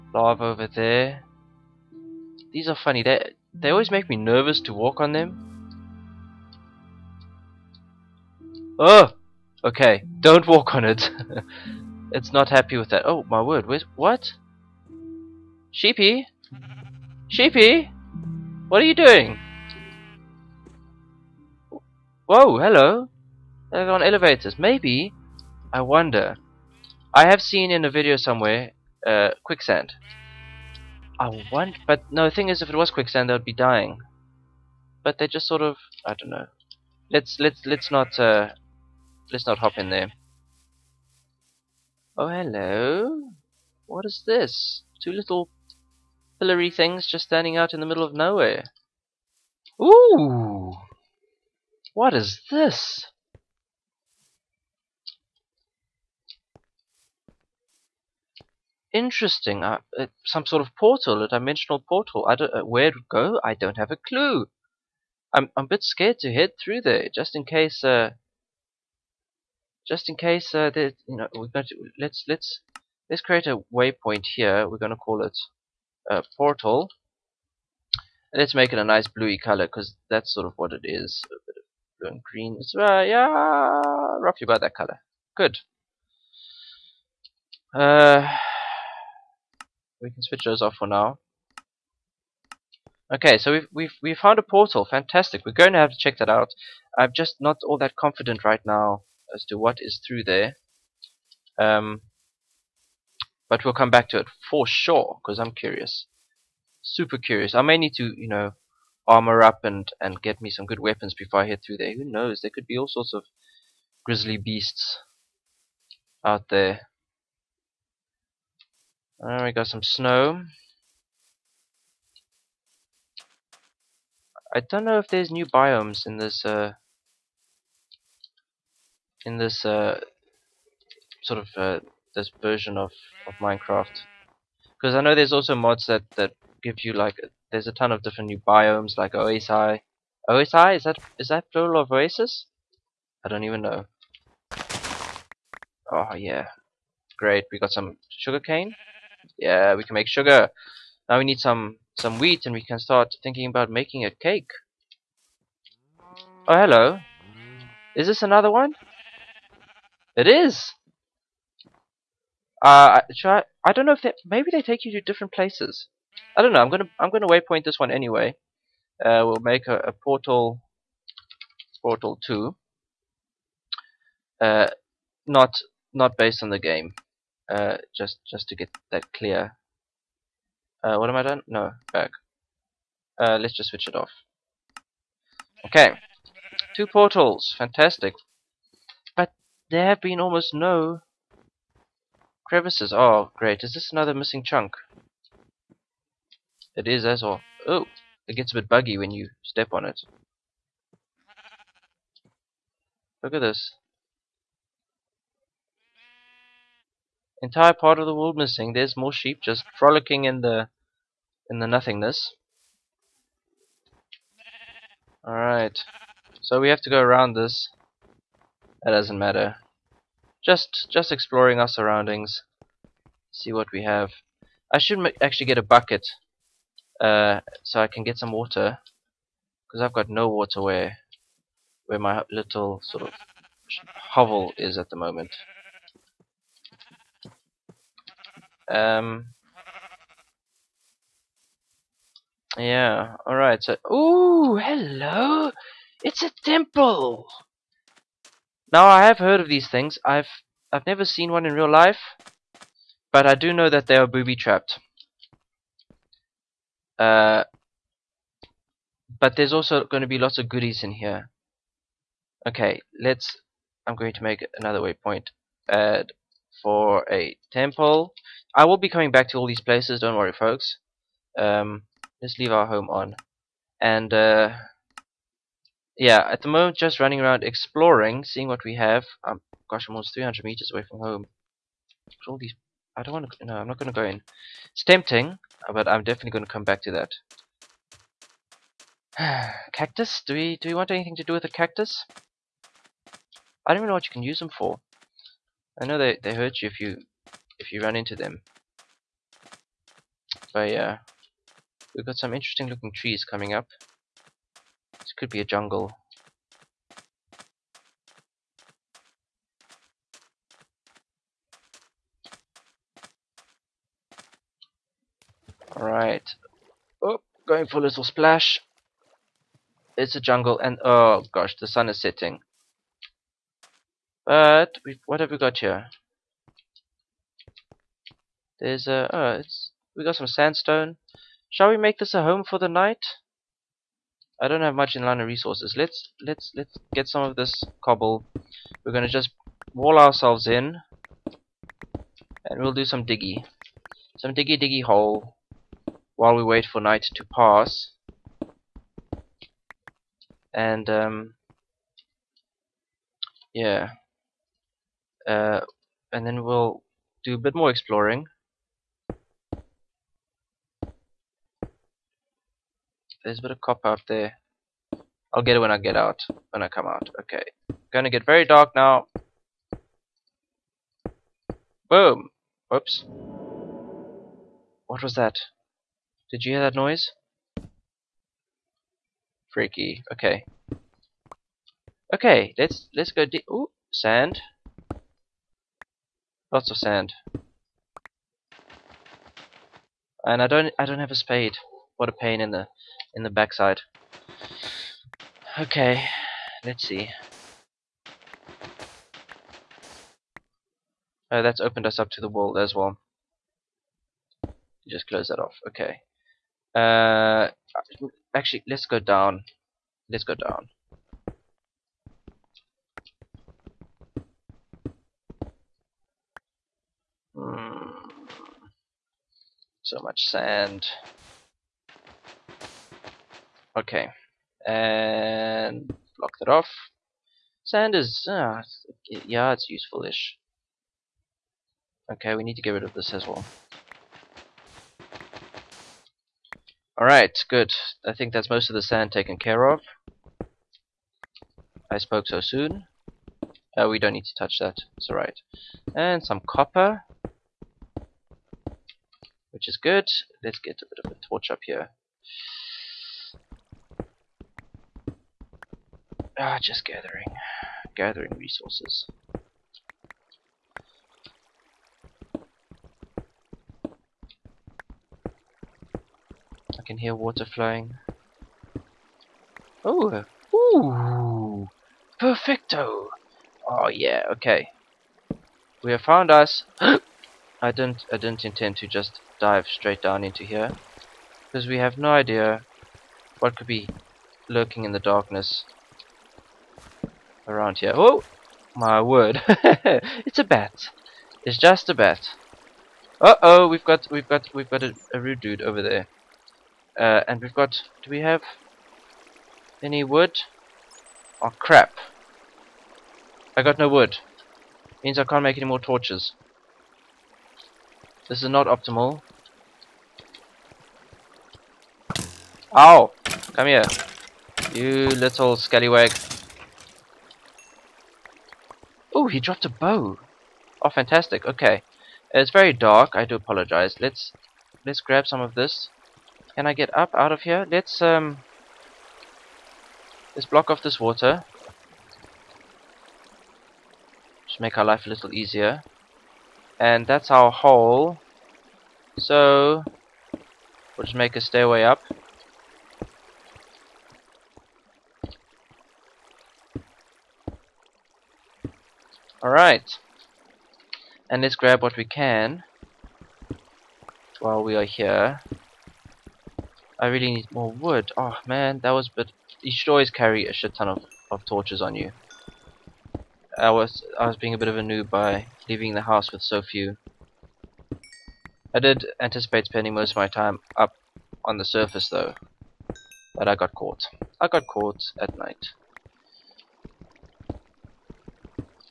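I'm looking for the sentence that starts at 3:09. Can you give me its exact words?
But there have been almost no Crevices.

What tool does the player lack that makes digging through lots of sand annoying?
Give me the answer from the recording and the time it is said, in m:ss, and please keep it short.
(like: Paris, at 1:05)
spade, at 6:30.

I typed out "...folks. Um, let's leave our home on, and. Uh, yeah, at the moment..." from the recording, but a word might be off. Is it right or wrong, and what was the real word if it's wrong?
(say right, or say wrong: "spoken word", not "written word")
right.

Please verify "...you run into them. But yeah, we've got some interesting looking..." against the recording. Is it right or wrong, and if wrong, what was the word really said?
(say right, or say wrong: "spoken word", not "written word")
right.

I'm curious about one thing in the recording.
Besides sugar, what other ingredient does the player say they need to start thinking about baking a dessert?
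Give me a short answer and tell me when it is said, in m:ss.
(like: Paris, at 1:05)
wheat, at 2:31.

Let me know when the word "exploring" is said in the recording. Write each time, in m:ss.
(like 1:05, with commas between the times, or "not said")
3:41, 4:37, 5:57.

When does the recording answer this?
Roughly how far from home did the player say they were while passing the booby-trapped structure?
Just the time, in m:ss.
4:39.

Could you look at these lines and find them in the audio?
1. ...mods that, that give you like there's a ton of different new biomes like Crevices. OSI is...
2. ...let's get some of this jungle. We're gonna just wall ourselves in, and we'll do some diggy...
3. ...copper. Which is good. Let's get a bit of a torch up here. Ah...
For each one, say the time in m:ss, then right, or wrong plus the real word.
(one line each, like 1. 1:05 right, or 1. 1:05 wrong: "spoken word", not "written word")
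1. 2:15 wrong: "OSI", not "Crevices"
2. 5:36 wrong: "cobble", not "jungle"
3. 7:26 right.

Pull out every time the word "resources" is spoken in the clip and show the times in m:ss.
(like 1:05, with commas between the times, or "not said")
5:35, 7:38.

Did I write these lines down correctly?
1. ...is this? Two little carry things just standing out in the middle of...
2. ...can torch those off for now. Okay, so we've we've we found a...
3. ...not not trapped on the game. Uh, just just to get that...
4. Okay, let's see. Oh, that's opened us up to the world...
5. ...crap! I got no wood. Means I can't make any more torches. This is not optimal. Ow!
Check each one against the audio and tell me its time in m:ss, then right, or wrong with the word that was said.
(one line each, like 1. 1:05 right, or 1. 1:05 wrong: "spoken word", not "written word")
1. 0:44 wrong: "pillory", not "carry"
2. 1:30 wrong: "switch", not "torch"
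3. 2:55 wrong: "based", not "trapped"
4. 6:35 right
5. 8:21 right.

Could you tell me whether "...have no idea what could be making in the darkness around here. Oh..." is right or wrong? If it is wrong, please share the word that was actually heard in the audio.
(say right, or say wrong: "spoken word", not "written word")
wrong: "lurking", not "making".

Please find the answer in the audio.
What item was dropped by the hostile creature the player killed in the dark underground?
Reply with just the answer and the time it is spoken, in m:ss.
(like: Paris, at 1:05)
bow, at 8:39.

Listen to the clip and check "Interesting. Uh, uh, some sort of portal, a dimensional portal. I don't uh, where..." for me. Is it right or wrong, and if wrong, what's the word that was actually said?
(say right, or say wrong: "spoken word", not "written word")
right.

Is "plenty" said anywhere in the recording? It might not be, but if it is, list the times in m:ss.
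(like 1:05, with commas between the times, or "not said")
not said.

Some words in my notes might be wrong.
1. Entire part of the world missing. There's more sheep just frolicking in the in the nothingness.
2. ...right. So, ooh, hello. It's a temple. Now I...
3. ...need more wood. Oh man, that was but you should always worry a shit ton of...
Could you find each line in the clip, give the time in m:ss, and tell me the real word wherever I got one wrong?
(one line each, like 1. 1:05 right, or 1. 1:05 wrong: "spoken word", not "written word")
1. 3:27 right
2. 4:03 right
3. 9:17 wrong: "carry", not "worry".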